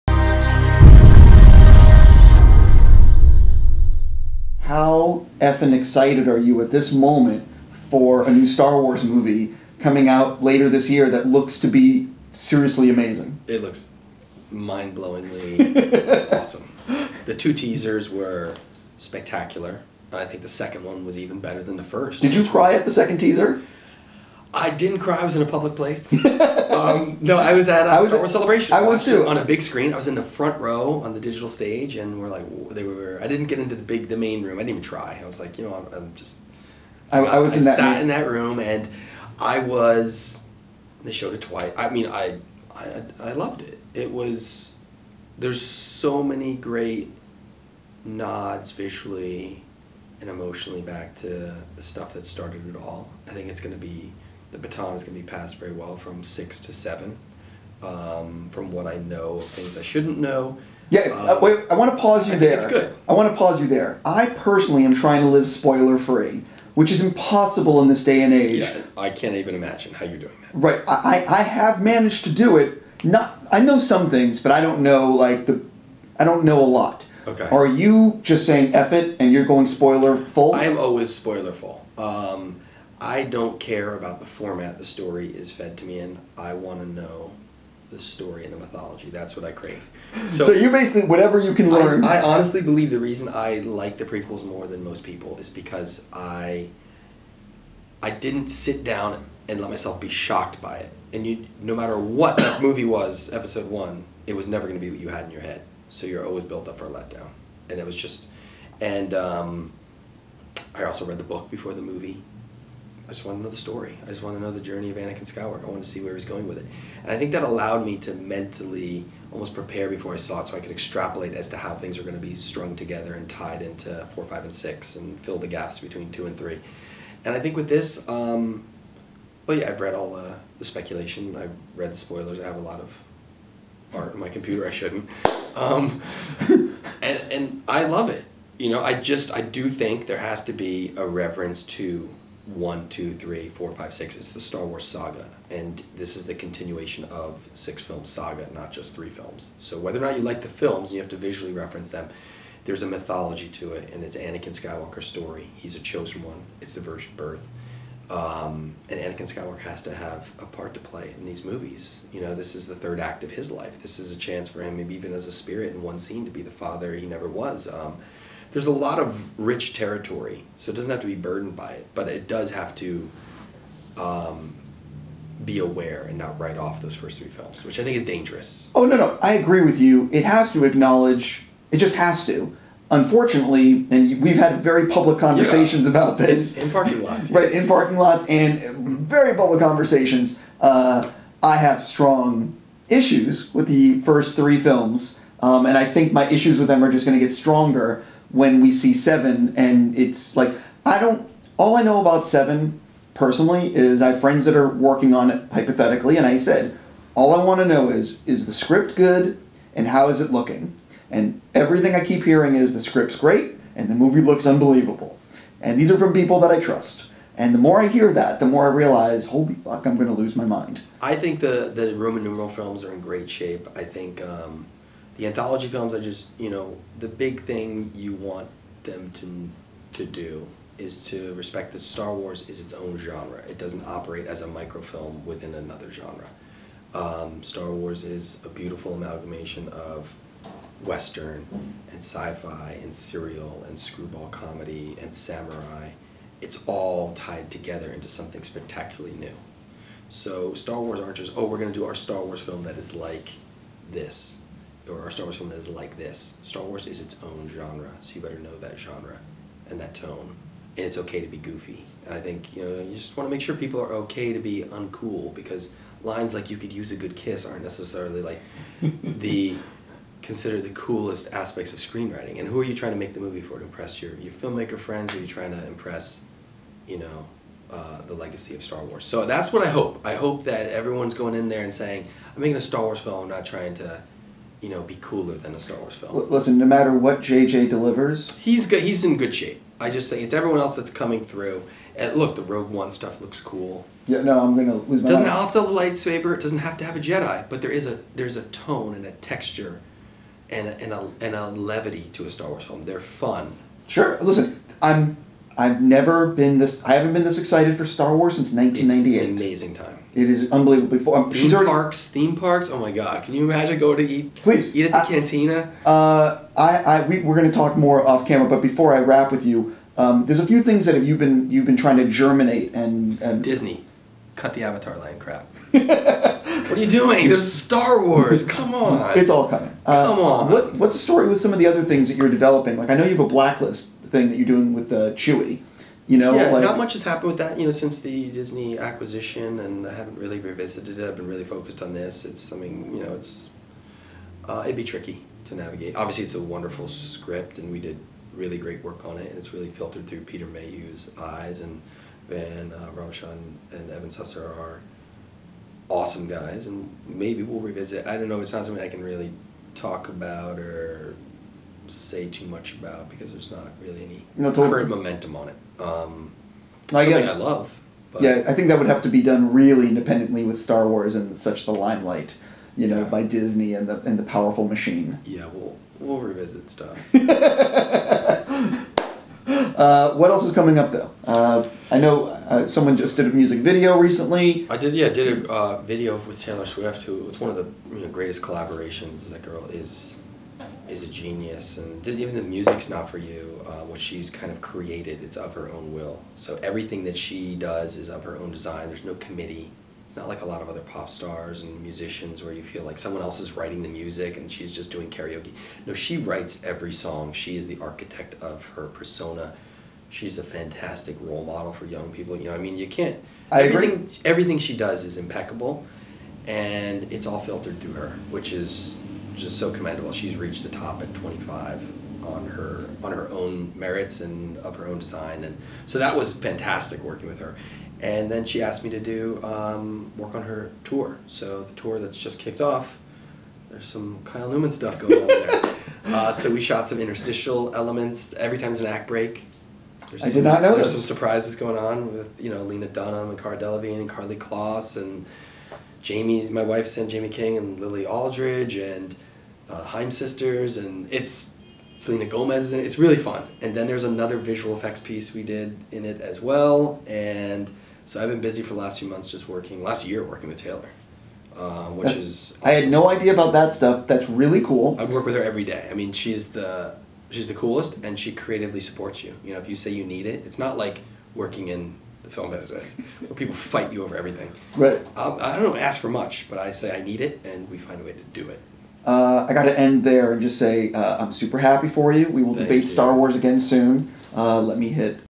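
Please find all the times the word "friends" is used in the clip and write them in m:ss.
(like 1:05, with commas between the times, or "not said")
3:24, 4:34.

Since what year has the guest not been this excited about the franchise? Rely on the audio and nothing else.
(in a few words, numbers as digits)
1998.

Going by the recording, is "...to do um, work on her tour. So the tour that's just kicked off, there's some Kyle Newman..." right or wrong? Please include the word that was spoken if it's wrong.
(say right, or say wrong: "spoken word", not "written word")
right.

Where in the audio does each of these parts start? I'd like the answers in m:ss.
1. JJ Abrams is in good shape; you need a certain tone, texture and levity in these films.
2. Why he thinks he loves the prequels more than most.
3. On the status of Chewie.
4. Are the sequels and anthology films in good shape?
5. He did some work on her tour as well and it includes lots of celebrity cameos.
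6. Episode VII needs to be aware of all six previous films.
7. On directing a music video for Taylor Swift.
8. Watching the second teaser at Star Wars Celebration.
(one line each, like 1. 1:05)
1. 4:46
2. 1:33
3. 5:31
4. 3:02
5. 7:08
6. 2:19
7. 6:20
8. 0:22.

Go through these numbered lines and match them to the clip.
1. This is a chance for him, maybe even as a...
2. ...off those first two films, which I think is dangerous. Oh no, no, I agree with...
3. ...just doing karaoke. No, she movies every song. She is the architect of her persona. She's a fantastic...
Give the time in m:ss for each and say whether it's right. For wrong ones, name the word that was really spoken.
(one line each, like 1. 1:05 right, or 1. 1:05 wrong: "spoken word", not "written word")
1. 2:43 right
2. 2:56 wrong: "three", not "two"
3. 6:44 wrong: "writes", not "movies".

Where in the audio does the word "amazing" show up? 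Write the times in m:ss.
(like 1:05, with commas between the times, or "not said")
0:12, 5:09.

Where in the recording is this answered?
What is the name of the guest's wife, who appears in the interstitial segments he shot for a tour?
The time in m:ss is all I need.
7:27.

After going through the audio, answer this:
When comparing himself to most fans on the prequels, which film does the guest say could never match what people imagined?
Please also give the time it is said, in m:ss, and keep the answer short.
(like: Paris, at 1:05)
Episode One, at 1:43.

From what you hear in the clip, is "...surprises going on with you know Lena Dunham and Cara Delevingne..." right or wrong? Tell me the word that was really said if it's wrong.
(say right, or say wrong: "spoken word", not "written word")
right.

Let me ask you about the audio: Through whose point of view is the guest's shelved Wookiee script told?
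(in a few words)
Peter Mayhew.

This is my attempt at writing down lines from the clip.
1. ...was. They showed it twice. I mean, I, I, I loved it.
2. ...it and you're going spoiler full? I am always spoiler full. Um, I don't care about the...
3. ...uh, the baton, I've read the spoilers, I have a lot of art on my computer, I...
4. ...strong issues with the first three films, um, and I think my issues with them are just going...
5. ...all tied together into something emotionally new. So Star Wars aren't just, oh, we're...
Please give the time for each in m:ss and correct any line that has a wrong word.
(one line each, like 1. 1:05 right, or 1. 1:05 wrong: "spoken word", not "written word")
1. 0:39 right
2. 1:18 right
3. 2:10 wrong: "speculation", not "baton"
4. 3:11 right
5. 4:06 wrong: "spectacularly", not "emotionally".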